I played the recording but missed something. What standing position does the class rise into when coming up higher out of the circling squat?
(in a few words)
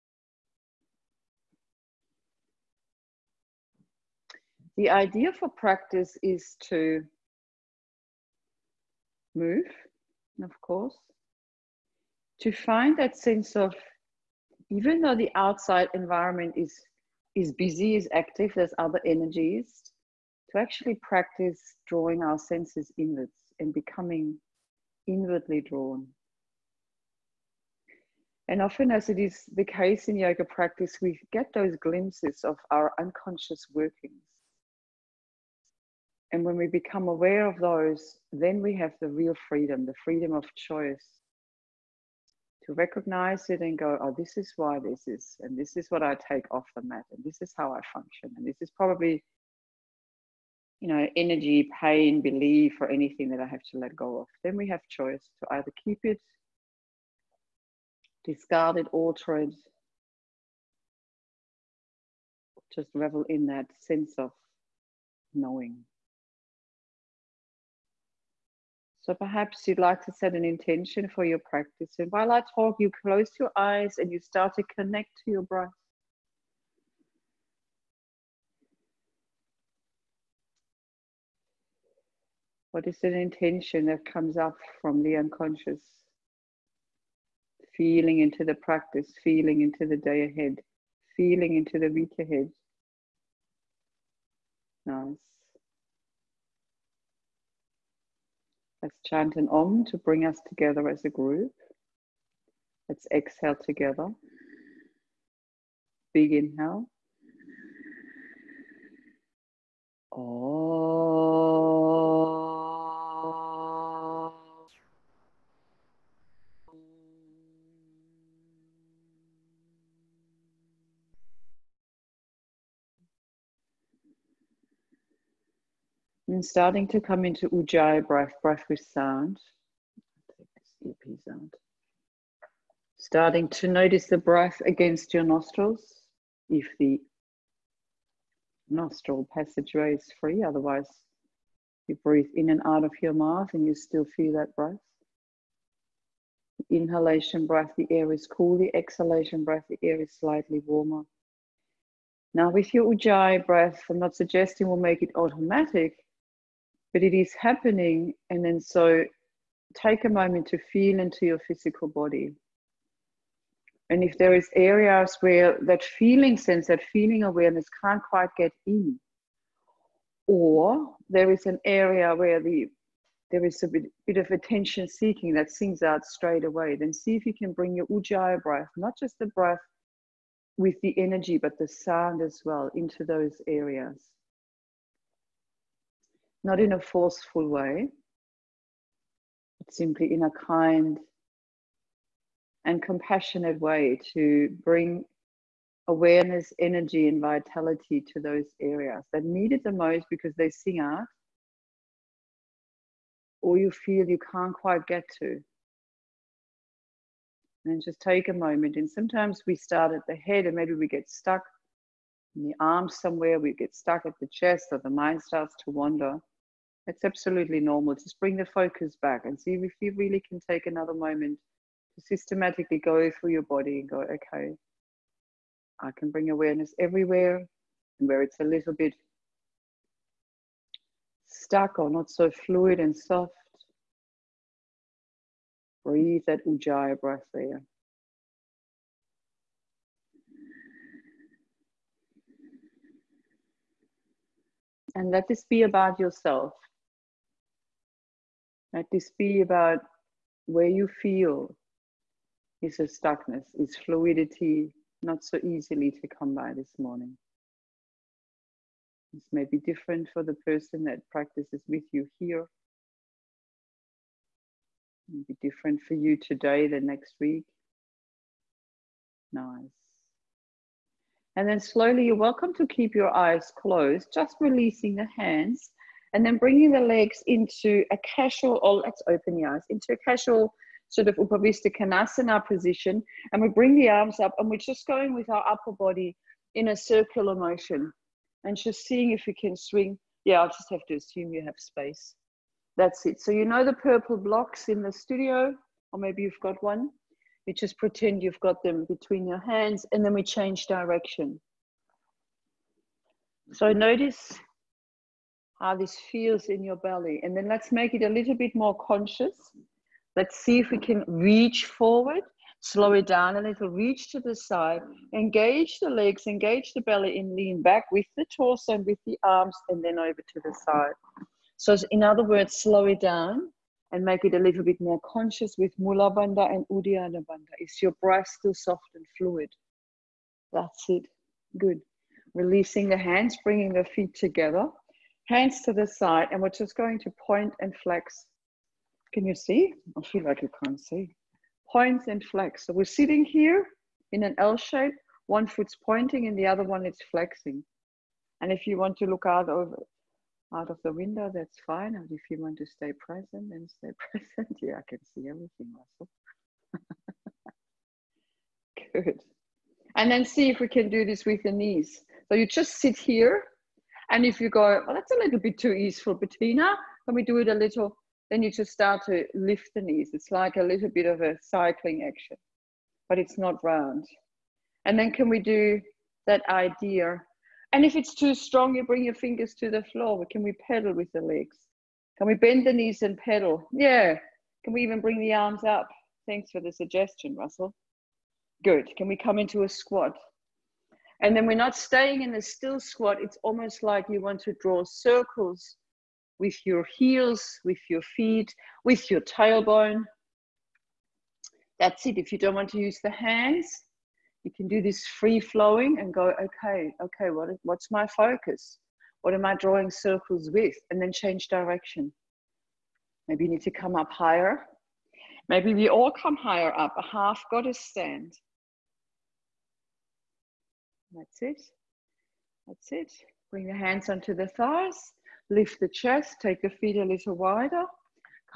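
half goddess stand.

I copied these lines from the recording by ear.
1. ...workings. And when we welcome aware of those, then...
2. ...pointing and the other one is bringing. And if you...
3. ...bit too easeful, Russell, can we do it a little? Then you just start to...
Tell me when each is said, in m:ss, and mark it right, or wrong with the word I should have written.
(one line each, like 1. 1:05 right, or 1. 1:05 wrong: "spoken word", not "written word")
1. 0:33 wrong: "become", not "welcome"
2. 5:45 wrong: "flexing", not "bringing"
3. 6:05 wrong: "Bettina", not "Russell".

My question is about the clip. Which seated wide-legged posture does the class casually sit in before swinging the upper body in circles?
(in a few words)
Upavista Konasana.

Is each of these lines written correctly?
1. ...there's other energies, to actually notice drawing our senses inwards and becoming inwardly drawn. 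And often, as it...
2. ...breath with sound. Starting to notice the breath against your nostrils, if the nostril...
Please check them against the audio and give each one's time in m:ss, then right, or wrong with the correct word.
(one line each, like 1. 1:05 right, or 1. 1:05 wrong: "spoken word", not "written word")
1. 0:18 wrong: "practice", not "notice"
2. 2:08 right.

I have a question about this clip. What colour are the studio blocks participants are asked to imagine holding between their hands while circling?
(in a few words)
purple.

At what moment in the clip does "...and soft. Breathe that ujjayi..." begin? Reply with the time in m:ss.
3:52.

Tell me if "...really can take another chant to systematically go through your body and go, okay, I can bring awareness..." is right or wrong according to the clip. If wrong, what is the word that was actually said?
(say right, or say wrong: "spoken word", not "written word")
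wrong: "moment", not "chant".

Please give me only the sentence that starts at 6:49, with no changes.
What am I drawing circles with?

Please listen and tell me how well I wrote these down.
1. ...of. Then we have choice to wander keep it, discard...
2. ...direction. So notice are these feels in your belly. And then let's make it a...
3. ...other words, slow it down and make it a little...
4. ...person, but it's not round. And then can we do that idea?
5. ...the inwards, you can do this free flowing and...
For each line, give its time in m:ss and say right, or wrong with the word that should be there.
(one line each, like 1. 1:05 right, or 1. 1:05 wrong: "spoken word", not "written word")
1. 0:54 wrong: "either", not "wander"
2. 5:00 right
3. 5:22 right
4. 6:12 wrong: "action", not "person"
5. 6:43 wrong: "hands", not "inwards".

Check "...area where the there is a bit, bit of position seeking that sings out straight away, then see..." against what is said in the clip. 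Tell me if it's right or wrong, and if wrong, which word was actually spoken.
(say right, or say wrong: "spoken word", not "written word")
wrong: "attention", not "position".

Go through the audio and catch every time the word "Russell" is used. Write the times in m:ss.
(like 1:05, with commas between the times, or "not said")
5:55, 6:27.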